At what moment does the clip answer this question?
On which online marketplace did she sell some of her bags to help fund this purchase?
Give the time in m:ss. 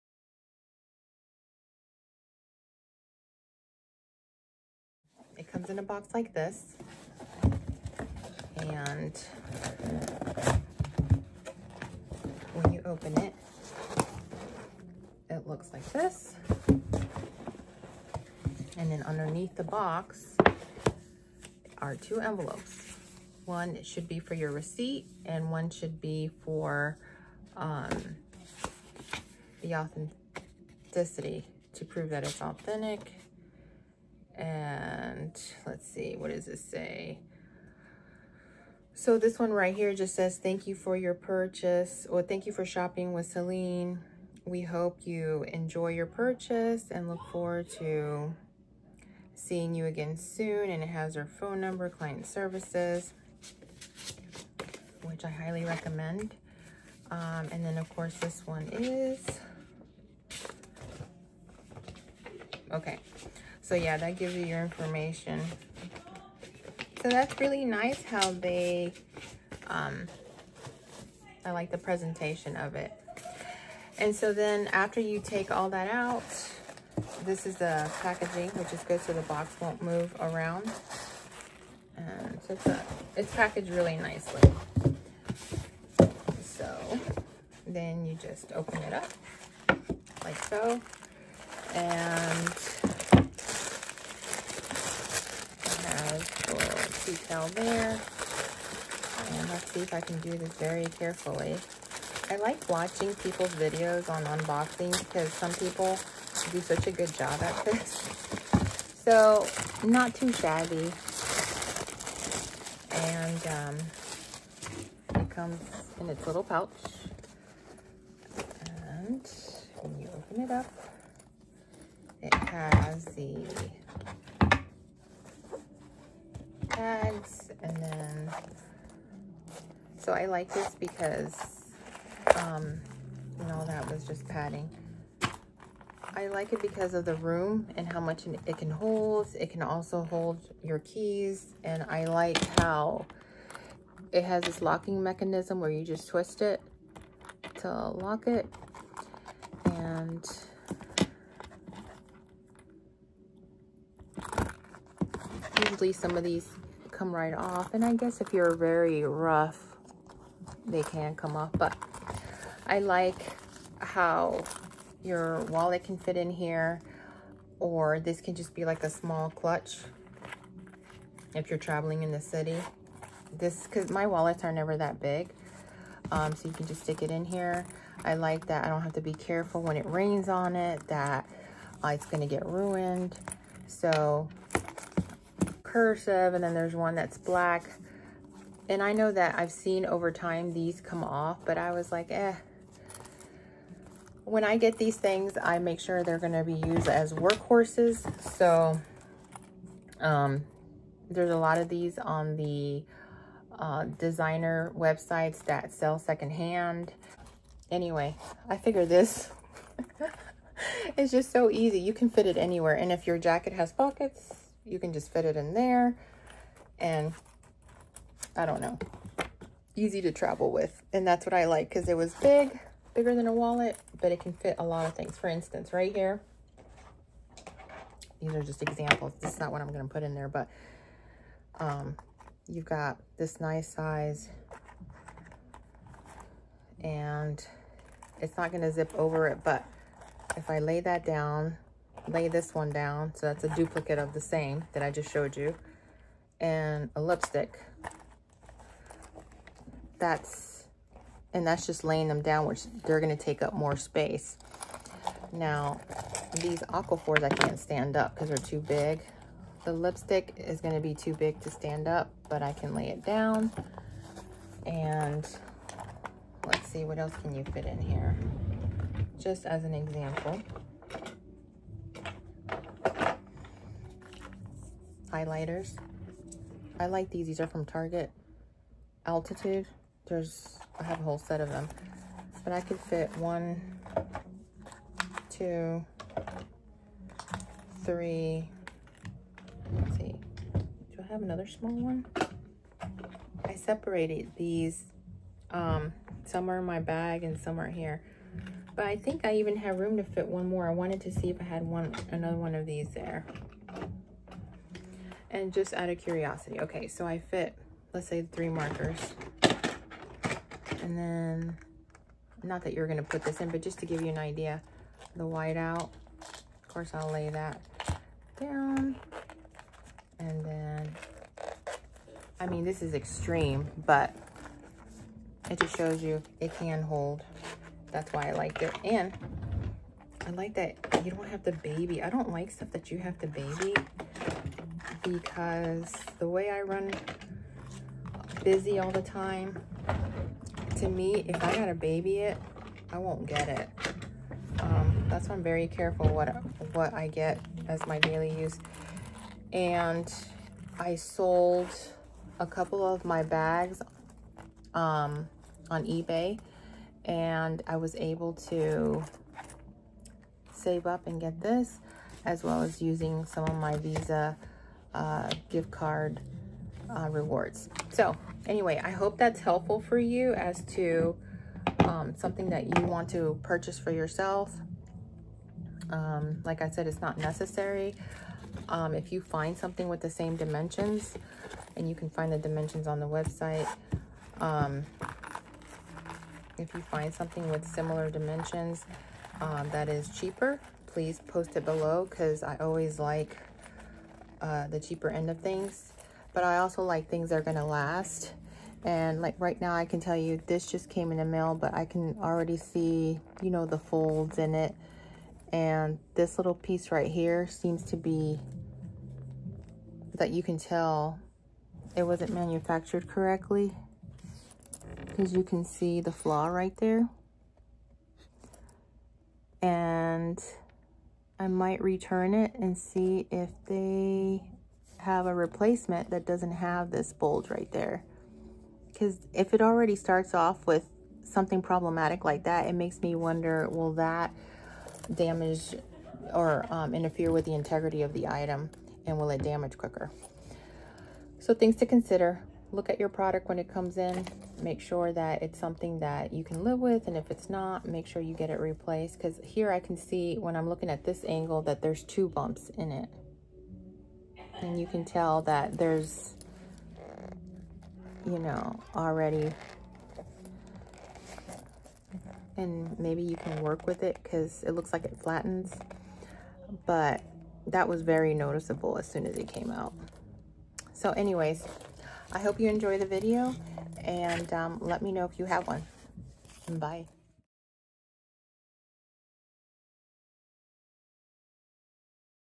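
5:55.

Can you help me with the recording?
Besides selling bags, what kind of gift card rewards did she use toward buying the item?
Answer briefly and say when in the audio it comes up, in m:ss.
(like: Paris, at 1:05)
Visa, at 6:03.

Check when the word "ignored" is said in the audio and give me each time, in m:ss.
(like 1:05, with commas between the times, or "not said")
not said.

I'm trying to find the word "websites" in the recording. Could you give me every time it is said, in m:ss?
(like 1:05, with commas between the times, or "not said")
3:24, 6:23.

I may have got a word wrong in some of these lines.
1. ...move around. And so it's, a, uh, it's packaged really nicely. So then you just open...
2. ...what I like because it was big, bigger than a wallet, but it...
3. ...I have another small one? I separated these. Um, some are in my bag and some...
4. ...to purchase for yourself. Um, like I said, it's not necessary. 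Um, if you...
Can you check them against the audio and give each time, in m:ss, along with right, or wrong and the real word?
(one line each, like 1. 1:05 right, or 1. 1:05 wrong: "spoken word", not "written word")
1. 1:19 right
2. 3:41 right
3. 4:51 right
4. 6:13 right.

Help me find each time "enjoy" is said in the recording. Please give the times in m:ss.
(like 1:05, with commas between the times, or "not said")
0:45, 7:52.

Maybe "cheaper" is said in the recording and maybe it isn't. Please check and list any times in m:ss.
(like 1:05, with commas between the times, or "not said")
6:30, 6:34.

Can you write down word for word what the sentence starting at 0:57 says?
Um, and then of course this one is, okay, so yeah, that gives you your information.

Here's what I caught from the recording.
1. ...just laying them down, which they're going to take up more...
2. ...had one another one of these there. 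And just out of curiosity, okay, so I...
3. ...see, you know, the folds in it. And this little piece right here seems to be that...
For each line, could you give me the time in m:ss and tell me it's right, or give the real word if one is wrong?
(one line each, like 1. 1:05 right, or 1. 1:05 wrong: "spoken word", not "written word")
1. 4:11 right
2. 5:01 right
3. 6:42 right.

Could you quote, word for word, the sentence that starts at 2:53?
This, because my wallets are never that big.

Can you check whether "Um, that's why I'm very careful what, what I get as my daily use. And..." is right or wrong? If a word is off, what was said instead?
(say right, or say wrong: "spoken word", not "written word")
right.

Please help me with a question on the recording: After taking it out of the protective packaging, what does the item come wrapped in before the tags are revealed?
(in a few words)
its little pouch.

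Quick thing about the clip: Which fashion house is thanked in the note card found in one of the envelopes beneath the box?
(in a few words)
Celine.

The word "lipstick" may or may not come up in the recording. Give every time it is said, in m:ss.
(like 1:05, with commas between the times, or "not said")
4:07, 4:19.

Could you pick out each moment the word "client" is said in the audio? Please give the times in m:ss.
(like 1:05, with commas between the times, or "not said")
0:51.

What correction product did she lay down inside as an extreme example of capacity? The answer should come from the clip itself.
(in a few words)
white out.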